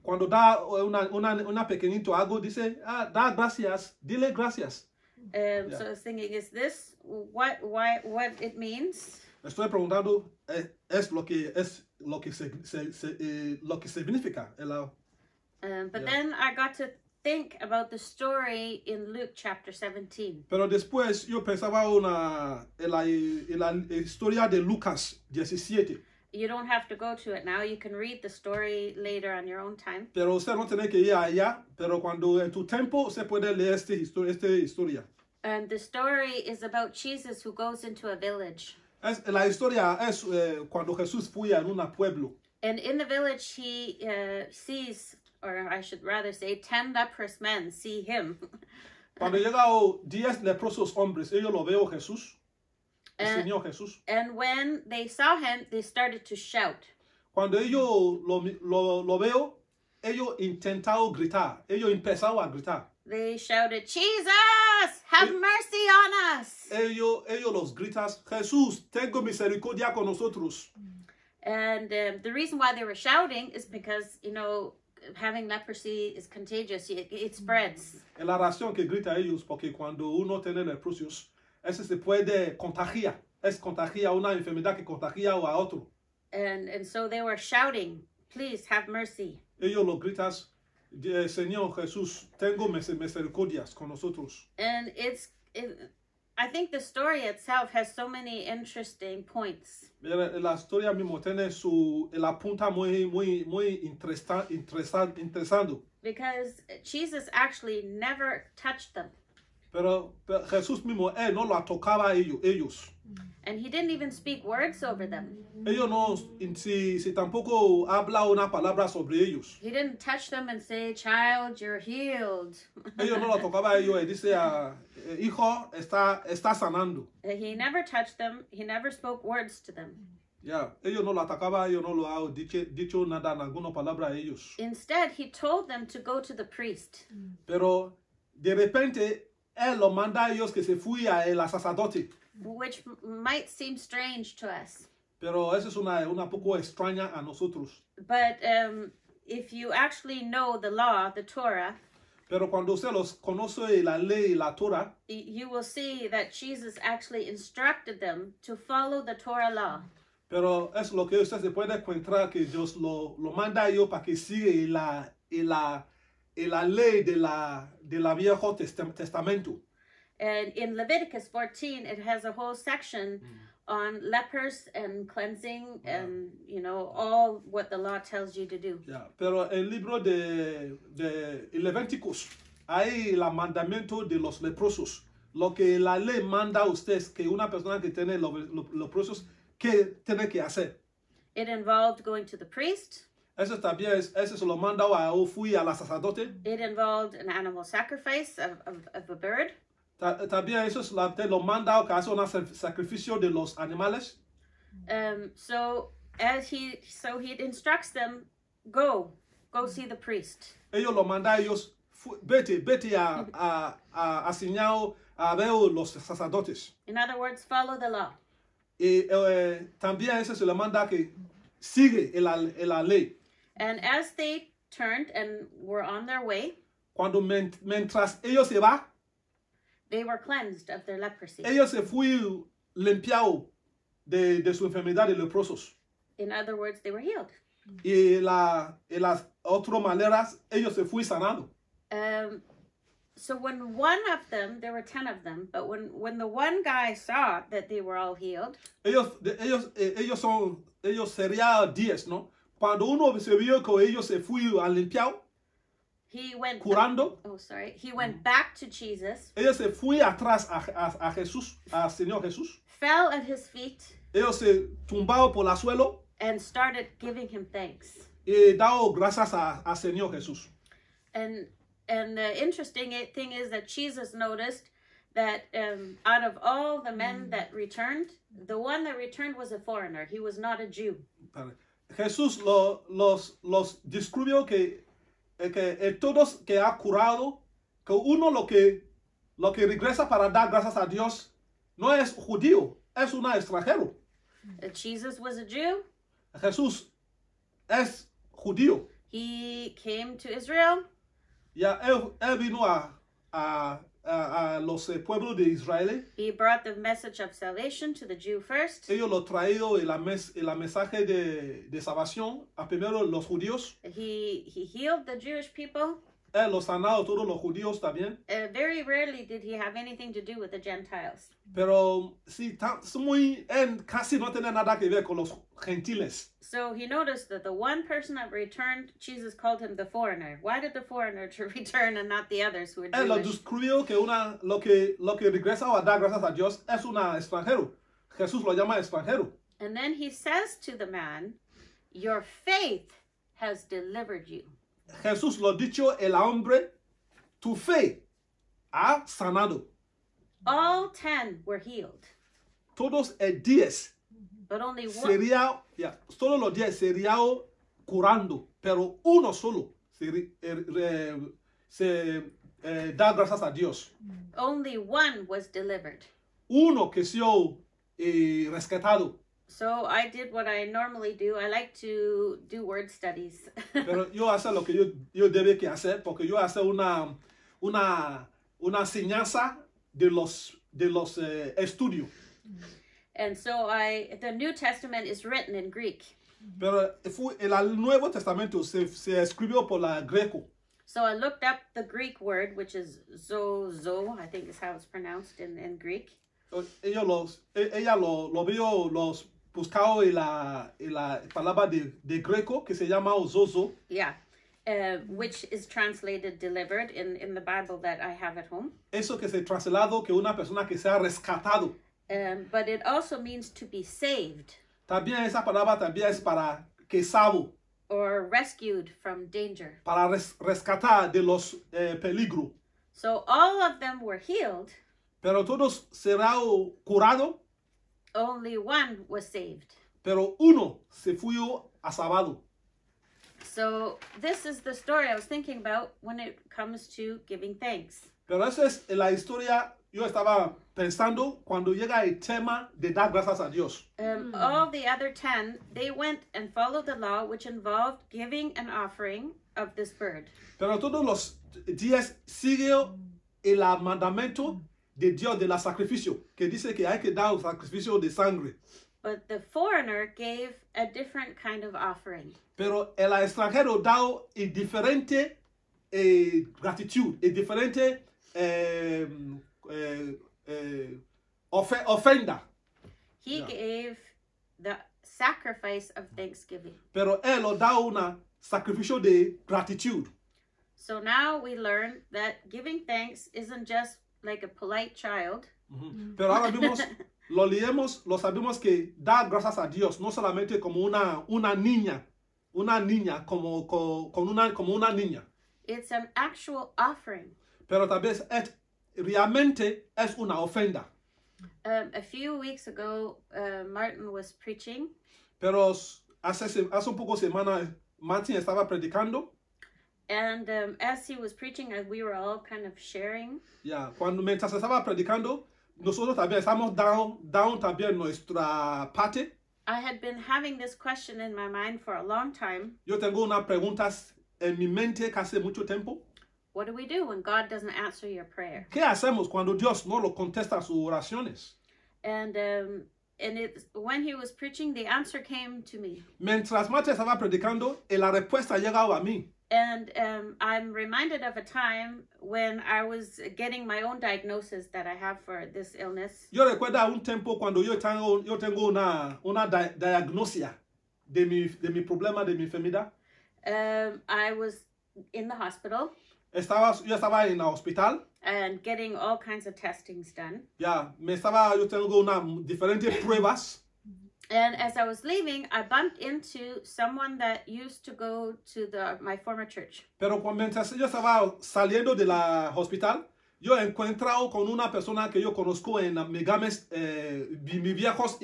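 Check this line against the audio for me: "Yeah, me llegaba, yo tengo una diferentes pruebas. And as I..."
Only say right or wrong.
wrong.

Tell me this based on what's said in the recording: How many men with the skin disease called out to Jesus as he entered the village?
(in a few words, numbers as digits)
10.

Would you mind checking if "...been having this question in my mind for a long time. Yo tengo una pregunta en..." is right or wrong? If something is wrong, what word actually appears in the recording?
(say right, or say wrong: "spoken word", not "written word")
right.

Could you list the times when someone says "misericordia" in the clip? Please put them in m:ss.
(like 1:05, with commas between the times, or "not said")
1:09, 1:32.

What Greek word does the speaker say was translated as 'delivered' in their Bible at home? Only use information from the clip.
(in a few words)
zozo.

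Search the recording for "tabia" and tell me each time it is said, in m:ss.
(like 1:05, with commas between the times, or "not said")
3:13, 3:20.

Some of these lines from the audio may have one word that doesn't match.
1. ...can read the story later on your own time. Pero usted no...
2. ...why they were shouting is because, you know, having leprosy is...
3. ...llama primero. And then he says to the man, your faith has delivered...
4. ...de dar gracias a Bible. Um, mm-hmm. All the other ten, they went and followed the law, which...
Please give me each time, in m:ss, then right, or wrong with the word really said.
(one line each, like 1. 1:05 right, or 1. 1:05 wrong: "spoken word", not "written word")
1. 0:27 right
2. 1:12 right
3. 5:38 wrong: "extranjero", not "primero"
4. 7:22 wrong: "Dios", not "Bible".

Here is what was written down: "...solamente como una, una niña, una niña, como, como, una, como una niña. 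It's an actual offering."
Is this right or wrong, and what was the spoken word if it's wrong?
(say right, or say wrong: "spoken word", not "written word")
right.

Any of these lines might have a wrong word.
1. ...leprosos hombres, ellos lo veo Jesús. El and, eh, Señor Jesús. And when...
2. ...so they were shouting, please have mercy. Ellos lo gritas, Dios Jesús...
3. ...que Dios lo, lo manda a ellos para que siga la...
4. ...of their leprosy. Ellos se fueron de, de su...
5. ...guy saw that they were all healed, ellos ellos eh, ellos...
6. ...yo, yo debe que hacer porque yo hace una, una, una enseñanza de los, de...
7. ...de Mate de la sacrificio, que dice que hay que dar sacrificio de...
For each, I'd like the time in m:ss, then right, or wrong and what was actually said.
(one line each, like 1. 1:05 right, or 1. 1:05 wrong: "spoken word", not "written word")
1. 0:50 right
2. 1:26 wrong: "Señor", not "Dios"
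3. 2:42 right
4. 3:50 right
5. 4:06 right
6. 6:14 right
7. 7:34 wrong: "Dios", not "Mate".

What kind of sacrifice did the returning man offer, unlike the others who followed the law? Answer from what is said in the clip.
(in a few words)
Sacrifice of thanksgiving.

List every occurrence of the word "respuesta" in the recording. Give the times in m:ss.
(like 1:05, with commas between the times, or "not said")
8:58.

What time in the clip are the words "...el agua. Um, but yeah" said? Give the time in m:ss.
0:14.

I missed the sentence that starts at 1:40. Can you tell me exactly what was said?
La historia mismo tiene su la punta muy muy muy interesante Because Jesus actually never touched them.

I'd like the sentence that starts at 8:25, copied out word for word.
Pero hace, hace un poco semana, Martin estaba predicando.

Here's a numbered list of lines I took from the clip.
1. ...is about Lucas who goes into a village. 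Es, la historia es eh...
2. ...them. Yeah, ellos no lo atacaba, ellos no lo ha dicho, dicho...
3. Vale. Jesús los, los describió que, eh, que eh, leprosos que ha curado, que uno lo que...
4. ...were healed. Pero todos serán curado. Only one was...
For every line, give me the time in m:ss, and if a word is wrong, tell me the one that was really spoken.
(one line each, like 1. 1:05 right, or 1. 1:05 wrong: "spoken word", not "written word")
1. 0:36 wrong: "Jesus", not "Lucas"
2. 2:09 right
3. 4:41 wrong: "todos", not "leprosos"
4. 7:03 right.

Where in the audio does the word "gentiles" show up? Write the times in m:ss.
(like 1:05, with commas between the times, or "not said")
5:20, 5:25.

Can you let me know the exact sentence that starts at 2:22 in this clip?
Which might seem strange to us.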